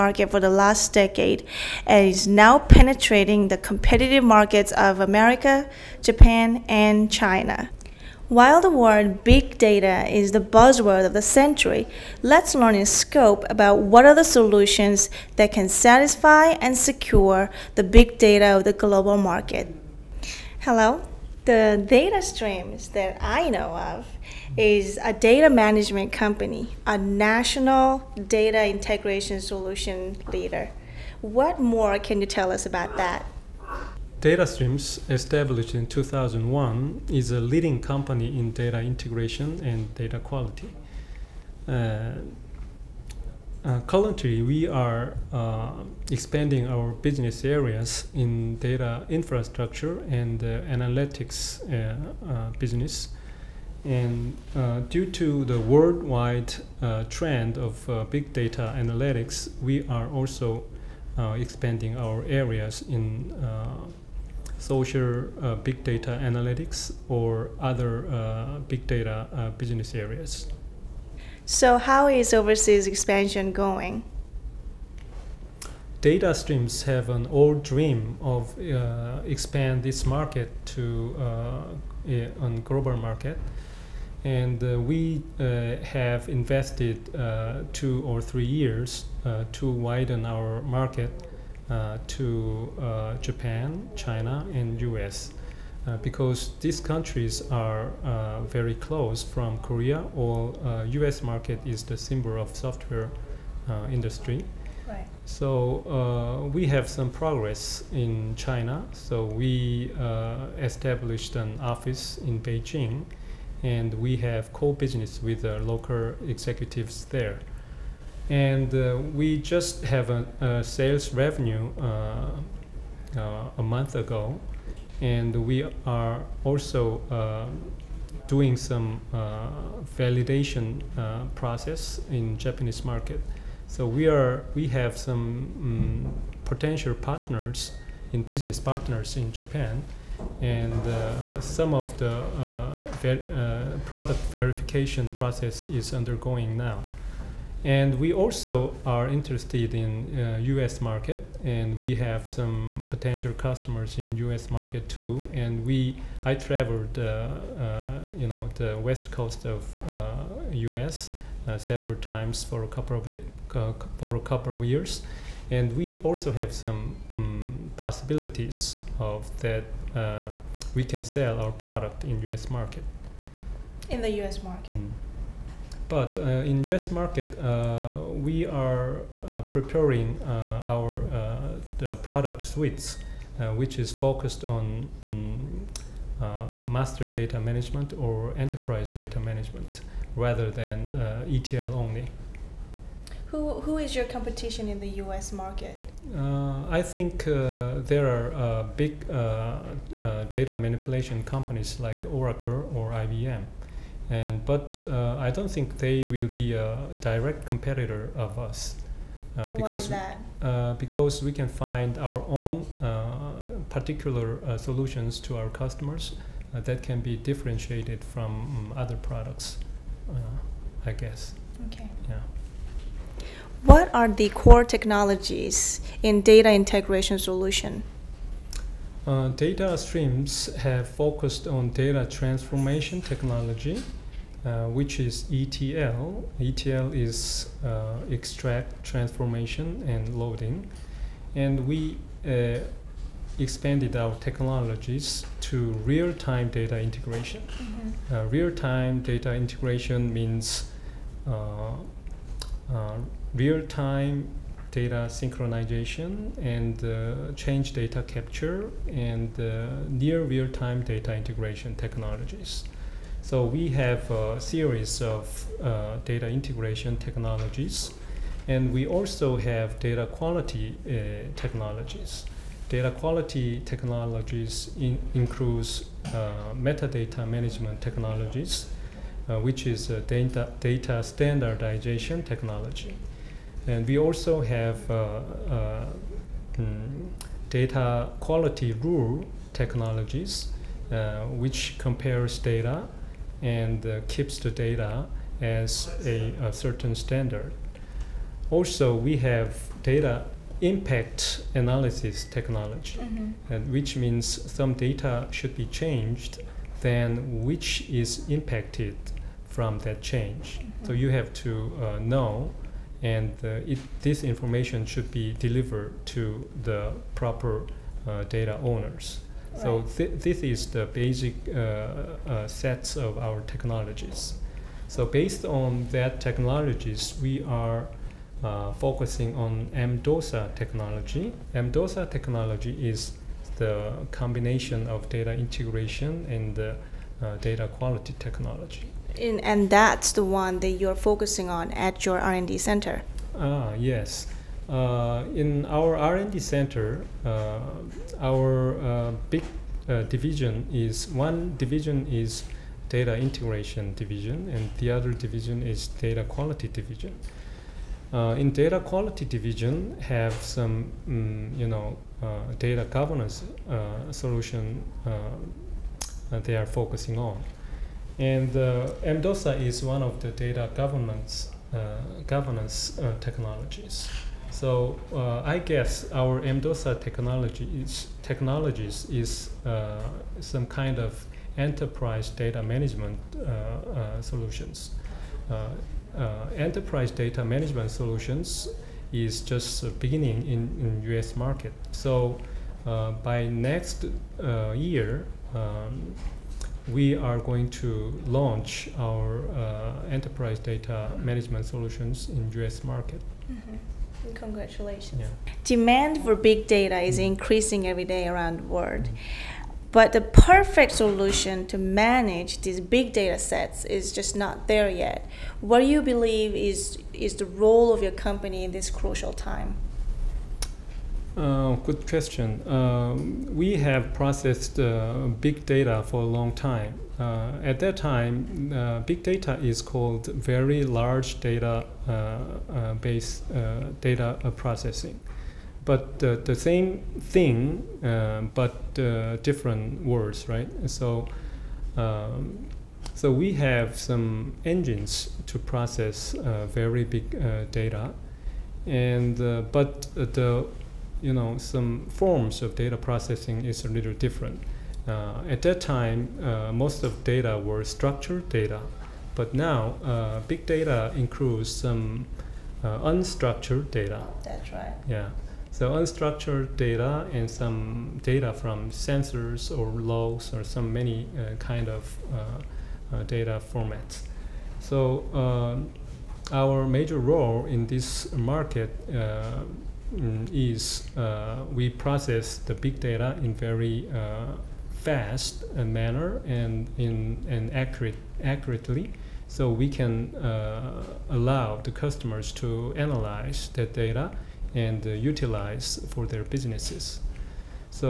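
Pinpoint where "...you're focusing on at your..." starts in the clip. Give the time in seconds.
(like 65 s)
340 s.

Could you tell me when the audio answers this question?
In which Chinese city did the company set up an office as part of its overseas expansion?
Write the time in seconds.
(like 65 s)
112 s.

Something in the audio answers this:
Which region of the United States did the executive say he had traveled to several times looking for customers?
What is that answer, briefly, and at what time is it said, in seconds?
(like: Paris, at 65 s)
West coast, at 158 s.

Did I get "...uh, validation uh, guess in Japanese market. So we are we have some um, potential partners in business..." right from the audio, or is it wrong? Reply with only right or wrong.
wrong.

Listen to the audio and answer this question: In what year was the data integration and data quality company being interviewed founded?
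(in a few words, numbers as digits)
2001.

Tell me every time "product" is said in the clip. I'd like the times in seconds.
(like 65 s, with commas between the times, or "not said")
143 s, 171 s, 181 s, 218 s.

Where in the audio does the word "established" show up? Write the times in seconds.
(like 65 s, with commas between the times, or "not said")
35 s, 110 s.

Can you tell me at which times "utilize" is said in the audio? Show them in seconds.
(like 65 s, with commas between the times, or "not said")
495 s.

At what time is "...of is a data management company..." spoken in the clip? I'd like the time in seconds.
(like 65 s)
23 s.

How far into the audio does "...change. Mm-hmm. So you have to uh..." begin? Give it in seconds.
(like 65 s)
309 s.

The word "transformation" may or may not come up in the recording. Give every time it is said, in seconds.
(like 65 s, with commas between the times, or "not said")
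232 s, 238 s.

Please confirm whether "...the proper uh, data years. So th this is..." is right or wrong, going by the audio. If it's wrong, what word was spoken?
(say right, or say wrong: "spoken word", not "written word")
wrong: "owners", not "years".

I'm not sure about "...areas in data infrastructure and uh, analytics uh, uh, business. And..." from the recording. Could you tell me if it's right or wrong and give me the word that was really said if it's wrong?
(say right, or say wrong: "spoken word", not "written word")
right.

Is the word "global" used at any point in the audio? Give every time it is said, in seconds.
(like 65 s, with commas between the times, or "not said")
18 s, 82 s.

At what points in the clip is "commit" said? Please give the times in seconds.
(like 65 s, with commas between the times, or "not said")
not said.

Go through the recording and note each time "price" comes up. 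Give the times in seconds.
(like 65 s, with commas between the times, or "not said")
not said.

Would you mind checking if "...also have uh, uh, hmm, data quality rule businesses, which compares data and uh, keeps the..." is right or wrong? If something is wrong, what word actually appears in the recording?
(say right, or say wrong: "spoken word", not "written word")
wrong: "technologies", not "businesses".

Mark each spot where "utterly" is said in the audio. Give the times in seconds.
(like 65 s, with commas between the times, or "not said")
not said.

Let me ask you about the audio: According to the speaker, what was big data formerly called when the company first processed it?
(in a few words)
Very large data.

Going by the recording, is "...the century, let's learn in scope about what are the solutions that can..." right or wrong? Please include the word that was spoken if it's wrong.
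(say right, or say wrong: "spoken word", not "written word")
right.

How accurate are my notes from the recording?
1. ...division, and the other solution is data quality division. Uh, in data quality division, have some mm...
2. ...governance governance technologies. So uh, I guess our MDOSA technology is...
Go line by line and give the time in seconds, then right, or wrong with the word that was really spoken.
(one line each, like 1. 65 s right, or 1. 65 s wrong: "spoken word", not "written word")
1. 353 s wrong: "division", not "solution"
2. 370 s right.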